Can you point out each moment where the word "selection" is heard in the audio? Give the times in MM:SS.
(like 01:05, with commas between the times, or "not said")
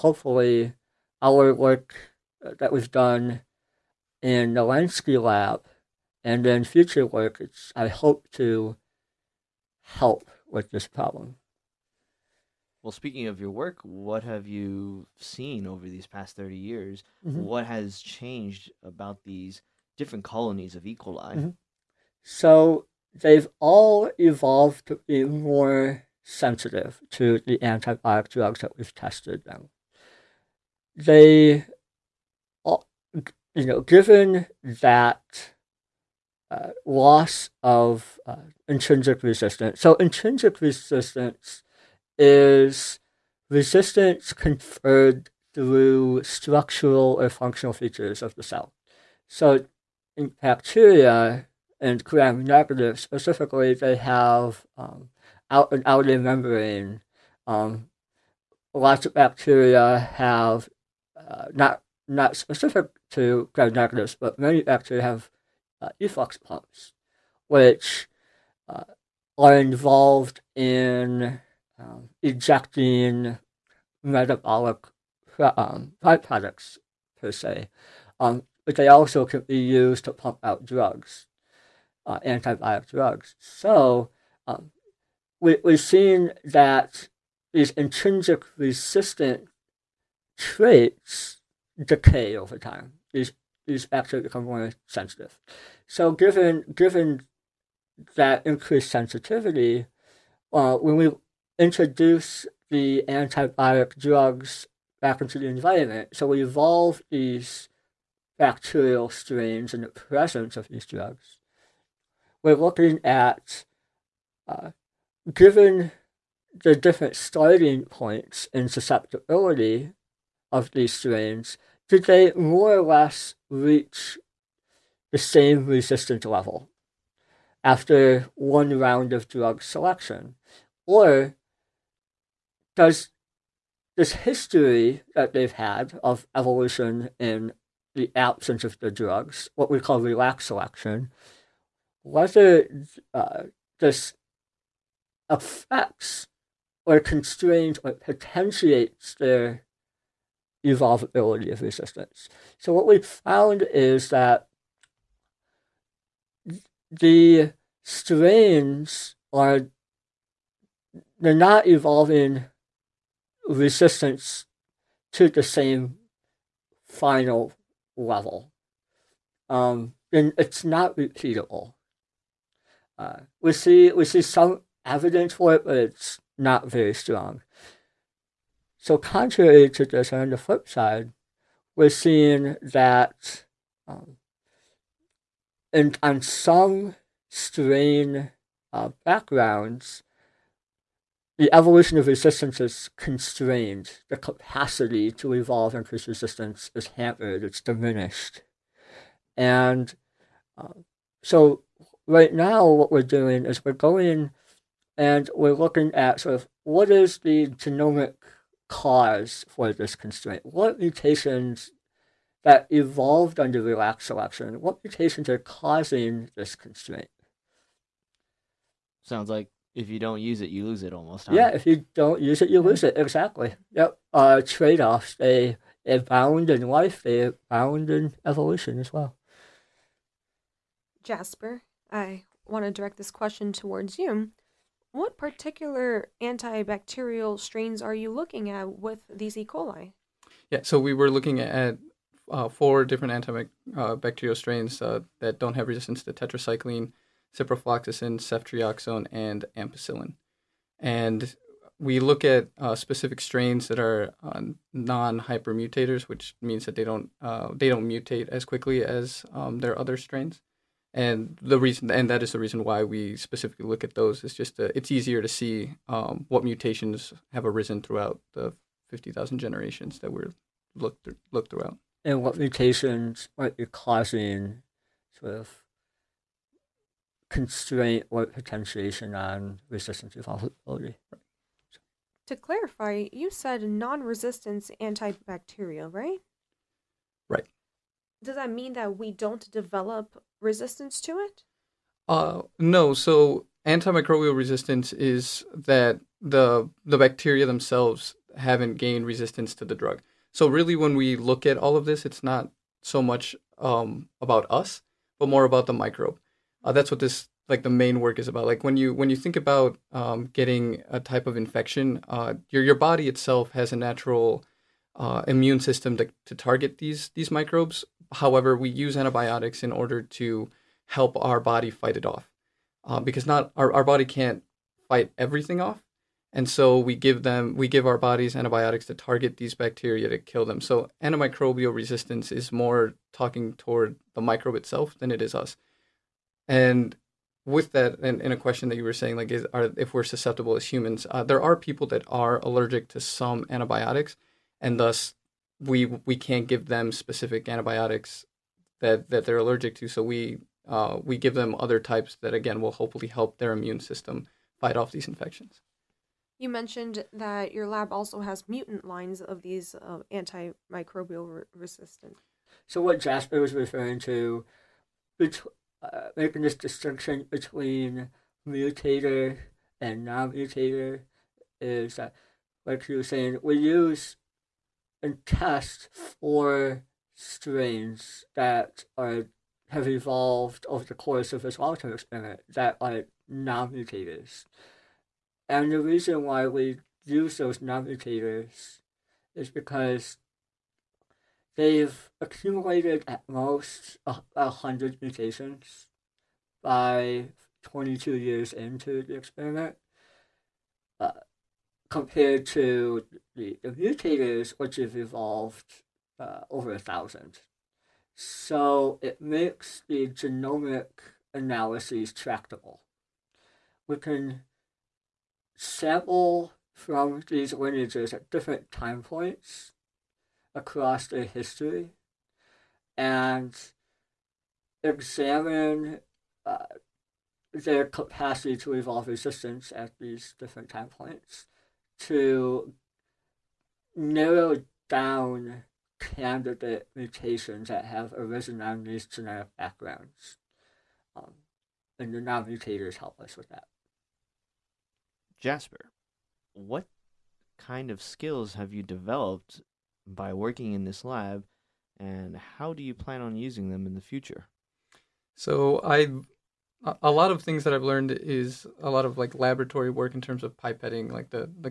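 02:09, 02:20, 03:34.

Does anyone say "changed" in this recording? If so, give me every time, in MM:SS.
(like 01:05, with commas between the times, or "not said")
00:17.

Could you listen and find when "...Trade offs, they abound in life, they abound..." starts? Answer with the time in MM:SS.
03:44.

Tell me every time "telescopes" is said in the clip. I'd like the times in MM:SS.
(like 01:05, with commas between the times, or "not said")
not said.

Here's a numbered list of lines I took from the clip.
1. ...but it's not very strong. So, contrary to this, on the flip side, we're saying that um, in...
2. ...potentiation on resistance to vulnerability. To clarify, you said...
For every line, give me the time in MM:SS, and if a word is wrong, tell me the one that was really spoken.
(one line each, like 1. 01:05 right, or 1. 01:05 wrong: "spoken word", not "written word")
1. 02:55 wrong: "seeing", not "saying"
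2. 04:38 right.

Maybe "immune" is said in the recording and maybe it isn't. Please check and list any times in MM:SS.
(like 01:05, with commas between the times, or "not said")
05:15, 05:53.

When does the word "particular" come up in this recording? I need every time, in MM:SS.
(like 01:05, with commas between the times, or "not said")
03:55.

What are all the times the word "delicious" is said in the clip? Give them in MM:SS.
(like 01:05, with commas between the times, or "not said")
not said.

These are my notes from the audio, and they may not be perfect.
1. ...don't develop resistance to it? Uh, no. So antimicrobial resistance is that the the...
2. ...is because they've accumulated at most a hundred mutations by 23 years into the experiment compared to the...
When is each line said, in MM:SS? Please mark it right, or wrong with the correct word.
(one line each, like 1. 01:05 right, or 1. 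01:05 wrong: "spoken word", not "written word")
1. 04:49 right
2. 06:29 wrong: "22", not "23".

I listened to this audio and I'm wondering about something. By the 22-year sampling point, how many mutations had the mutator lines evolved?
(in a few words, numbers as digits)
Over 1,000.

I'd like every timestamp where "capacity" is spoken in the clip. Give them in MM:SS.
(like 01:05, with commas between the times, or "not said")
03:14, 07:07.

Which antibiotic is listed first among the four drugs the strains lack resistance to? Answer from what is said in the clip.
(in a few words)
Tetracycline.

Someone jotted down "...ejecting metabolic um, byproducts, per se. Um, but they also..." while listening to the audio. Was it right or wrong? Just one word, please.
right.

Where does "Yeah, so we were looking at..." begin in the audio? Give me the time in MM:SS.
04:00.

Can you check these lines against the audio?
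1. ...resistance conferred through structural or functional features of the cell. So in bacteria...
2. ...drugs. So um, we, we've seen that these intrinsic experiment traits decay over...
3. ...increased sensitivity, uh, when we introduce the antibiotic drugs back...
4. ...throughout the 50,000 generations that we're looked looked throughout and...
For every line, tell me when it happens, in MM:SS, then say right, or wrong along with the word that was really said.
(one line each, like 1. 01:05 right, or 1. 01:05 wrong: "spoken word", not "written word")
1. 00:43 right
2. 01:22 wrong: "resistant", not "experiment"
3. 01:38 right
4. 04:27 right.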